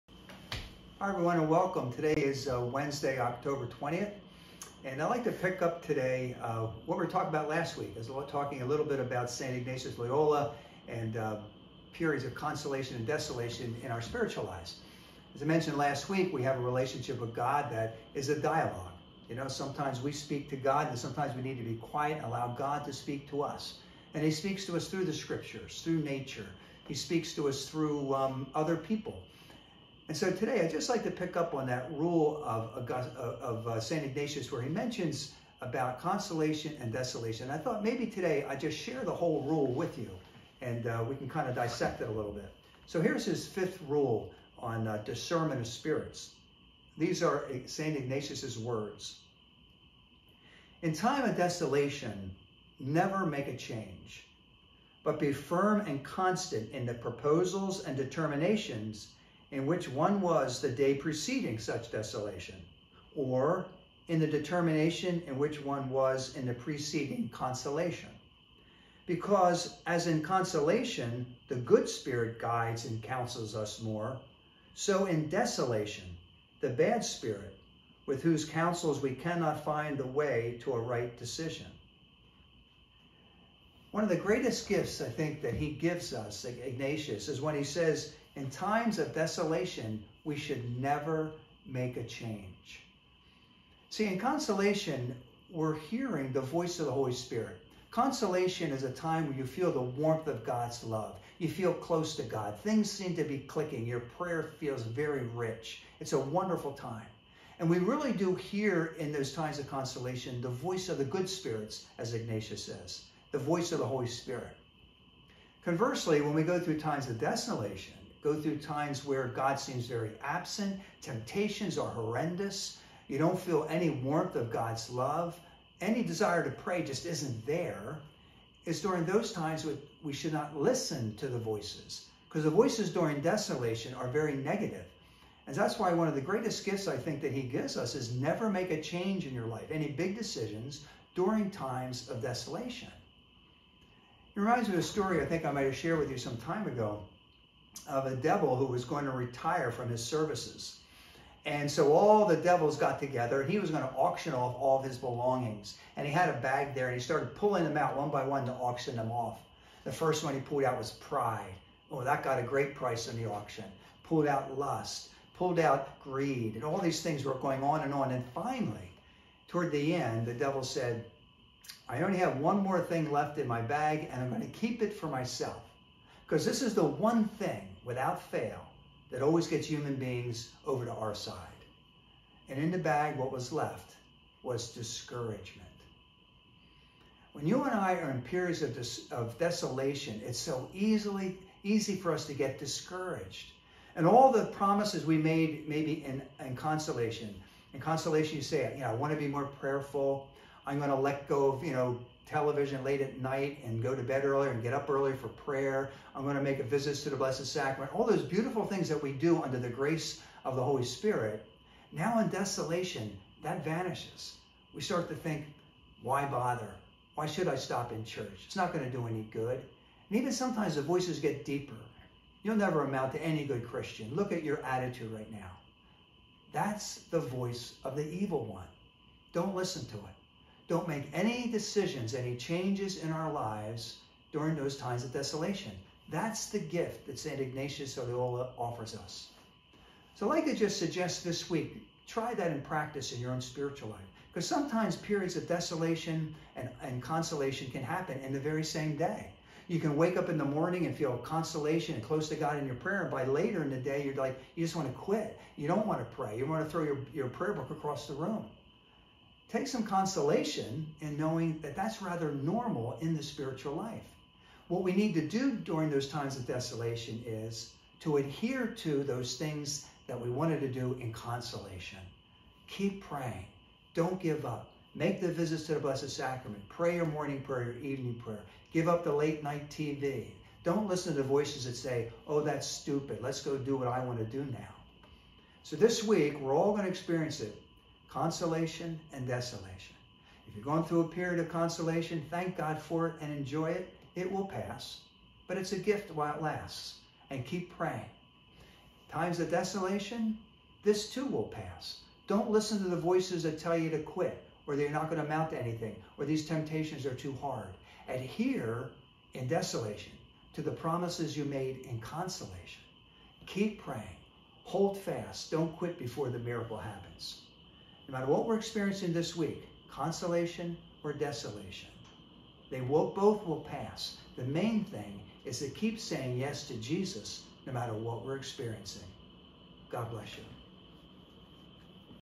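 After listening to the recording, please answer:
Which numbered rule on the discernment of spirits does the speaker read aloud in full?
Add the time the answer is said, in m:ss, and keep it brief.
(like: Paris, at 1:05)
Fifth rule, at 0:43.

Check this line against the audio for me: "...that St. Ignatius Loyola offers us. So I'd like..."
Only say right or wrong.
right.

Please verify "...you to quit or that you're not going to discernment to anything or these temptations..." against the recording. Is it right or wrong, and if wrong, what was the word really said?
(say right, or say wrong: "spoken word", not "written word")
wrong: "amount", not "discernment".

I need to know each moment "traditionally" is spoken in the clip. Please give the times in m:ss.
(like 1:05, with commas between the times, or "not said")
not said.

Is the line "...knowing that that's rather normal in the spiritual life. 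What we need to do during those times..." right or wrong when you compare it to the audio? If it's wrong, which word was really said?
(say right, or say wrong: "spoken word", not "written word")
right.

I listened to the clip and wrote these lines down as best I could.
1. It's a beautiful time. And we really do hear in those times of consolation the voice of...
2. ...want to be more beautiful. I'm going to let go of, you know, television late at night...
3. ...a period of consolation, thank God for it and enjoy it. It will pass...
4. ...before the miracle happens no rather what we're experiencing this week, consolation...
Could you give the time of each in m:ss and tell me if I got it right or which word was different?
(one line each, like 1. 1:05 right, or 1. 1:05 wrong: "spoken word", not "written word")
1. 1:45 wrong: "wonderful", not "beautiful"
2. 3:18 wrong: "prayerful", not "beautiful"
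3. 4:51 right
4. 5:15 wrong: "matter", not "rather".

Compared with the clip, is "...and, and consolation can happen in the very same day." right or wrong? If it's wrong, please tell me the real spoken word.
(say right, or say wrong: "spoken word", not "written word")
right.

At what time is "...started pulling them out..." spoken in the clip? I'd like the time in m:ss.
2:37.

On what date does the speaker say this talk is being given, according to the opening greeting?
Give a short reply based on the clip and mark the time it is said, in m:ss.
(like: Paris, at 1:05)
Wednesday, October 20th, at 0:02.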